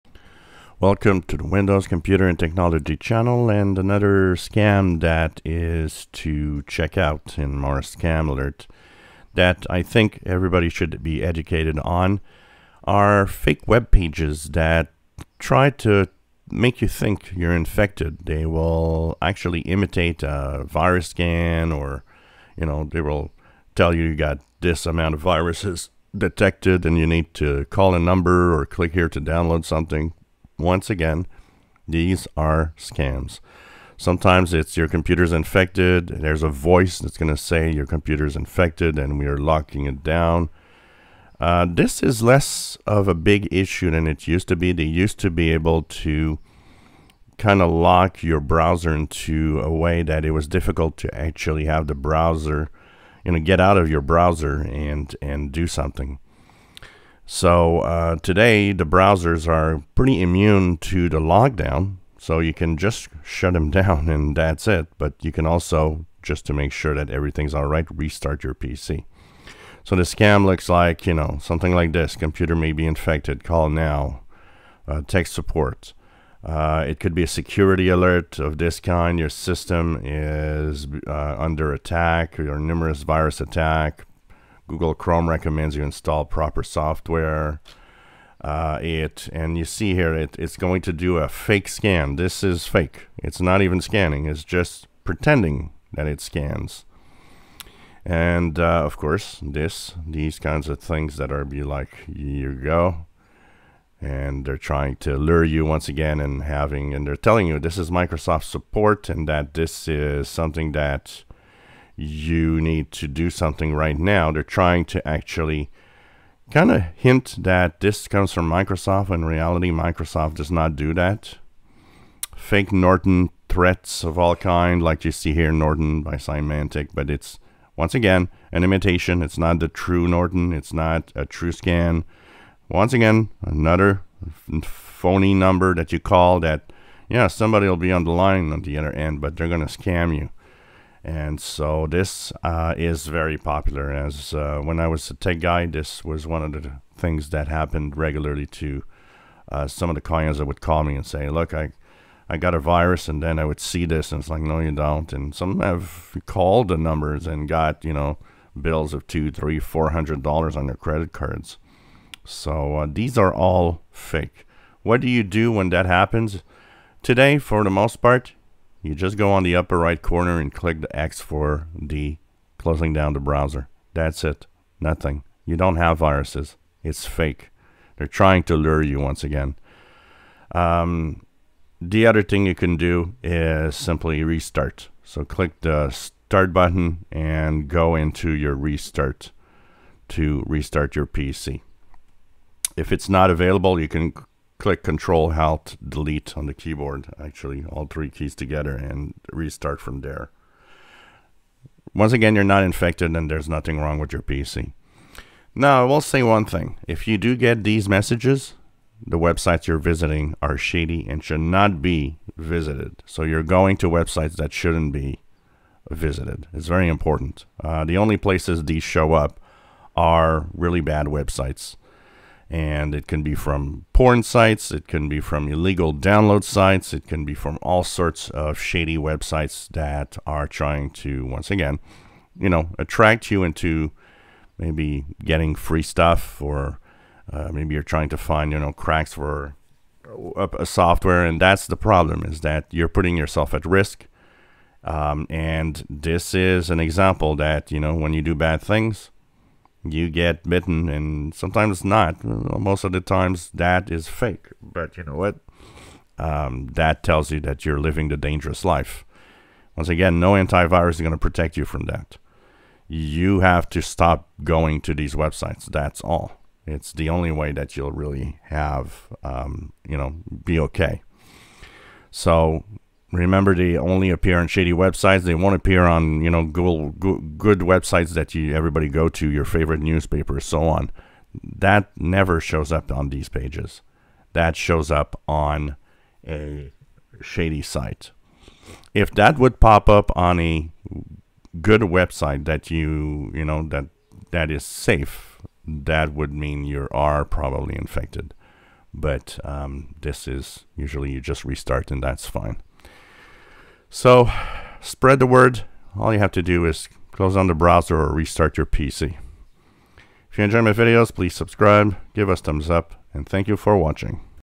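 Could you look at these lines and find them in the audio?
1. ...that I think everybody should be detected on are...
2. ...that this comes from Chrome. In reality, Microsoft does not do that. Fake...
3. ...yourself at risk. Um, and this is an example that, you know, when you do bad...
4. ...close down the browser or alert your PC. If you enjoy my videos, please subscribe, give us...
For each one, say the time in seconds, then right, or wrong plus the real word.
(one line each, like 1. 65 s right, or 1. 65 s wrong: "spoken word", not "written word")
1. 9 s wrong: "educated", not "detected"
2. 117 s wrong: "Microsoft", not "Chrome"
3. 243 s right
4. 307 s wrong: "restart", not "alert".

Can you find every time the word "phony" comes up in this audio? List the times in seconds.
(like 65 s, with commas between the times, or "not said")
134 s.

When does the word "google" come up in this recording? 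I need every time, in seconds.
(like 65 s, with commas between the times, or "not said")
84 s, 276 s.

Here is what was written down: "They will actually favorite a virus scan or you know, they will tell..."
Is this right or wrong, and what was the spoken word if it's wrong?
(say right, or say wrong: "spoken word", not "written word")
wrong: "imitate", not "favorite".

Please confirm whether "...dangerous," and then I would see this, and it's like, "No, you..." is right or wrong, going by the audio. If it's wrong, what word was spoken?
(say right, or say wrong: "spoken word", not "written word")
wrong: "virus", not "dangerous".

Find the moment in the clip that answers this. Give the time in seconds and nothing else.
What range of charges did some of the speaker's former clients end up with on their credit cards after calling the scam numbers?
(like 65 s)
159 s.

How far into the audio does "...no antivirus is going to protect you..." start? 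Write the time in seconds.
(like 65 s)
260 s.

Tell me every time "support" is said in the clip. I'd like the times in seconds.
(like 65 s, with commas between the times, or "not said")
75 s, 108 s.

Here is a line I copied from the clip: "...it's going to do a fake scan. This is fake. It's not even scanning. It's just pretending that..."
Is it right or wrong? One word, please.
right.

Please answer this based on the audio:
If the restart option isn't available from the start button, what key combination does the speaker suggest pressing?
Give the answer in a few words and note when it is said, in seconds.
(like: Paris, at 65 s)
Control Alt Delete, at 194 s.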